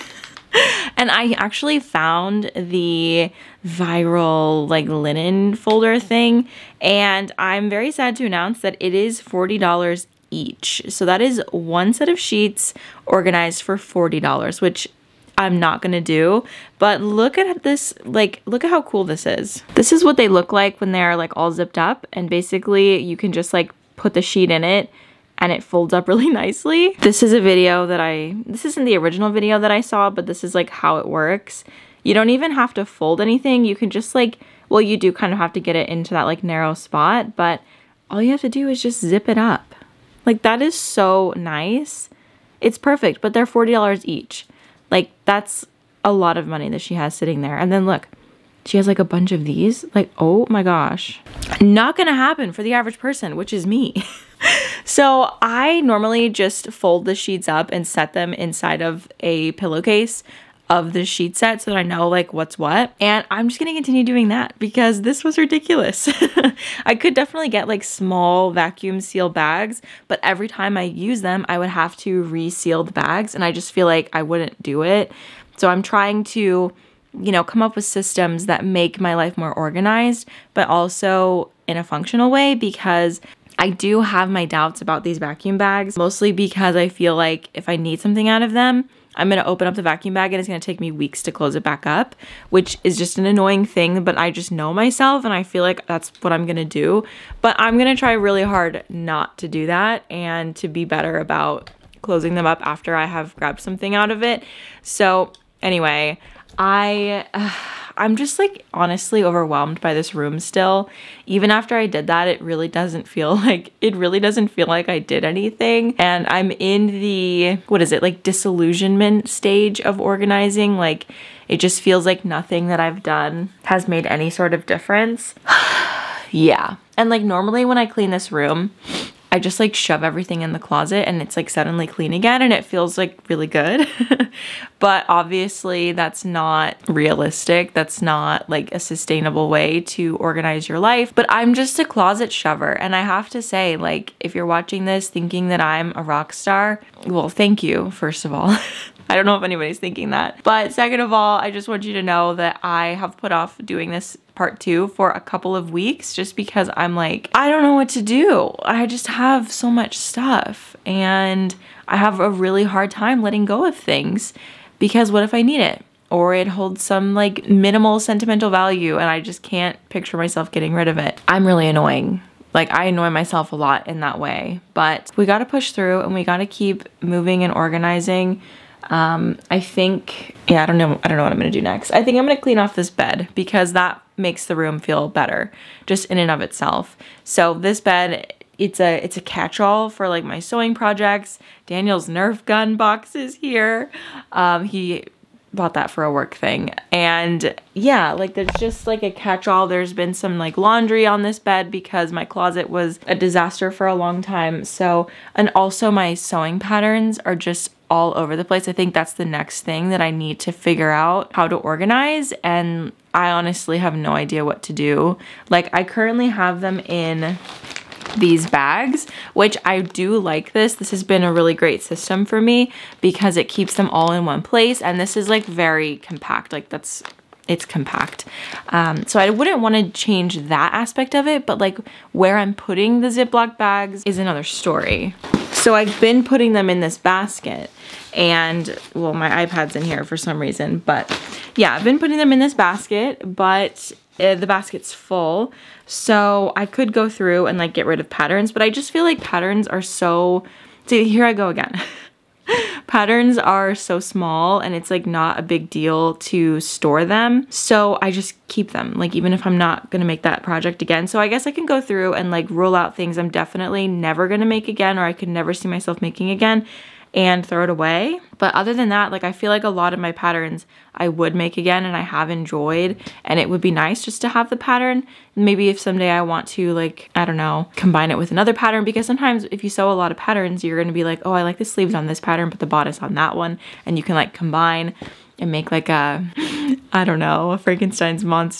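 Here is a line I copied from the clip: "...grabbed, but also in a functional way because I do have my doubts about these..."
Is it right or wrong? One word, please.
wrong.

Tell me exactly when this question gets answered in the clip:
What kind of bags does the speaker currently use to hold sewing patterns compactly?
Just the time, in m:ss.
3:53.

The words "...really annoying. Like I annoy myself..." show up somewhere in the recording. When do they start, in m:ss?
2:51.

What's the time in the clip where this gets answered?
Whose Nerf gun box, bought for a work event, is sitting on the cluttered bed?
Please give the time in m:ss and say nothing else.
3:11.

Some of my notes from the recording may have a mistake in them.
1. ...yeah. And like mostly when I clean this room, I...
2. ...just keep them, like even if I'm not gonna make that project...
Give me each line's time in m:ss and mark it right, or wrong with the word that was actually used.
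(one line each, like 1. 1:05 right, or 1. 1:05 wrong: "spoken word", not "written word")
1. 2:06 wrong: "normally", not "mostly"
2. 4:18 right.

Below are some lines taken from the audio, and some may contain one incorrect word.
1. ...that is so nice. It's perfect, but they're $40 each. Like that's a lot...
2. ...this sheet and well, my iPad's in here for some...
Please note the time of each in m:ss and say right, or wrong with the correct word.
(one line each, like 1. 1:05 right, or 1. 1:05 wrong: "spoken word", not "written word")
1. 0:40 right
2. 3:56 wrong: "basket", not "sheet".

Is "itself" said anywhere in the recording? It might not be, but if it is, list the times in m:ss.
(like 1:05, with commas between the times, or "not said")
3:06.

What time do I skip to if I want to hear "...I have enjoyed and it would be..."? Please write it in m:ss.
4:31.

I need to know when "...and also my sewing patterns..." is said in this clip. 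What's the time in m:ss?
3:25.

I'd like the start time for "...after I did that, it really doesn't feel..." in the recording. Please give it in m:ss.
1:51.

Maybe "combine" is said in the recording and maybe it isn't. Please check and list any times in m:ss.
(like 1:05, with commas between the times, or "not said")
4:37, 4:44.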